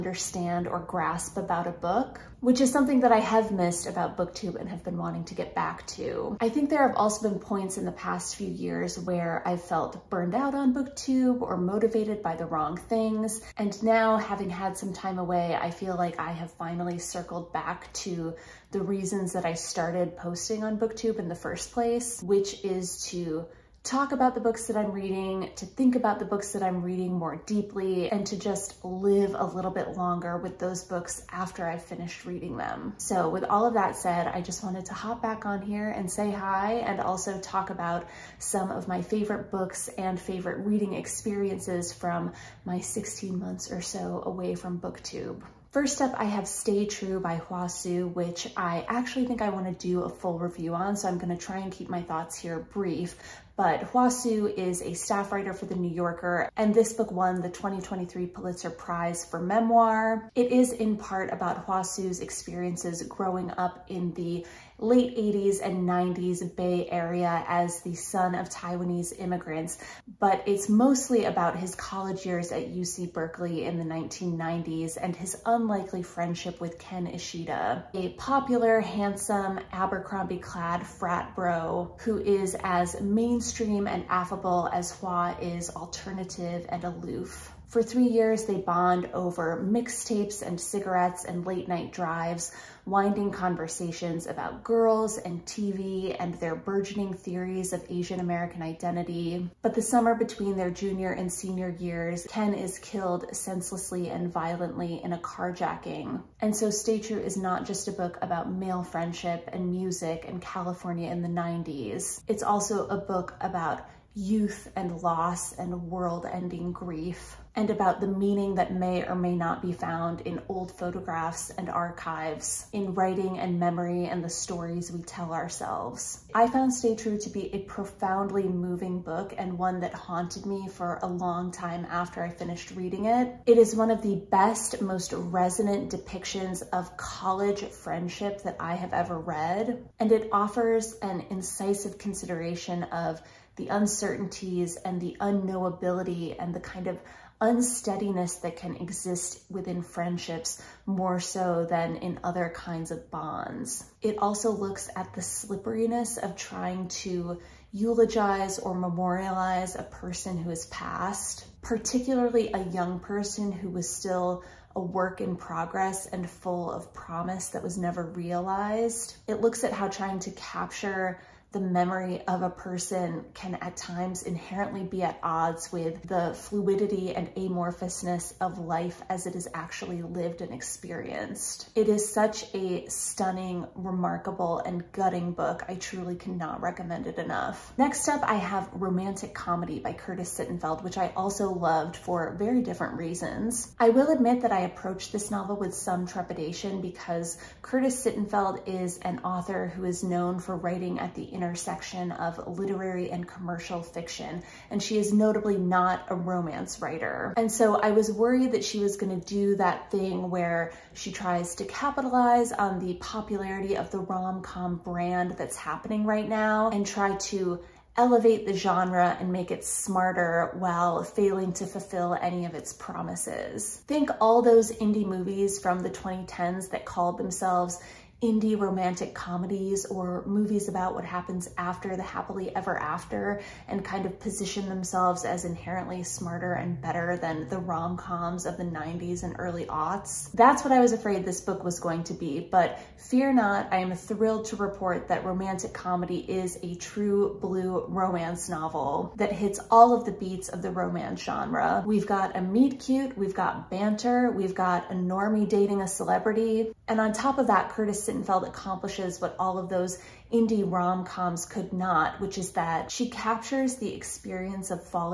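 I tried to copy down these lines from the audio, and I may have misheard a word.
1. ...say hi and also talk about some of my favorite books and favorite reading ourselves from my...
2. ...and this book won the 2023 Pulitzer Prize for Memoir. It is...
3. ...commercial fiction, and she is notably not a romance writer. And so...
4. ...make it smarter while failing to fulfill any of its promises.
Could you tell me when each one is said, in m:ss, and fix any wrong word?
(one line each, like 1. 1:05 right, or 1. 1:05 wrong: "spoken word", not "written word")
1. 0:36 wrong: "experiences", not "ourselves"
2. 0:56 right
3. 3:23 right
4. 3:39 right.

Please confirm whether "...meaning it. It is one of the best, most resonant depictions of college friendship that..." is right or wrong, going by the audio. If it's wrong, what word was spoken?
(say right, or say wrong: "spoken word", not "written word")
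wrong: "reading", not "meaning".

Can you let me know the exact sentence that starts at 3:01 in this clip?
It is such a stunning, remarkable, and gutting book.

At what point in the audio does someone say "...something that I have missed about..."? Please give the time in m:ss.
0:02.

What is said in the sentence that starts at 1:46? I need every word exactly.
And so Stay True is not just a book about male friendship and music and California in the 90s.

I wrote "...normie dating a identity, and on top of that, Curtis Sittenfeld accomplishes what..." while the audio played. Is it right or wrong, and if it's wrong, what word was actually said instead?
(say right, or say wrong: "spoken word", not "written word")
wrong: "celebrity", not "identity".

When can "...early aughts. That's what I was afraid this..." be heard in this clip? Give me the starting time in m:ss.
3:59.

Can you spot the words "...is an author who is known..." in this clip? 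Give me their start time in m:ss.
3:18.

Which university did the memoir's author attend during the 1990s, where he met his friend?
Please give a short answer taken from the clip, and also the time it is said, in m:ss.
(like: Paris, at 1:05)
UC Berkeley, at 1:12.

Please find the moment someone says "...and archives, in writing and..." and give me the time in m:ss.
2:01.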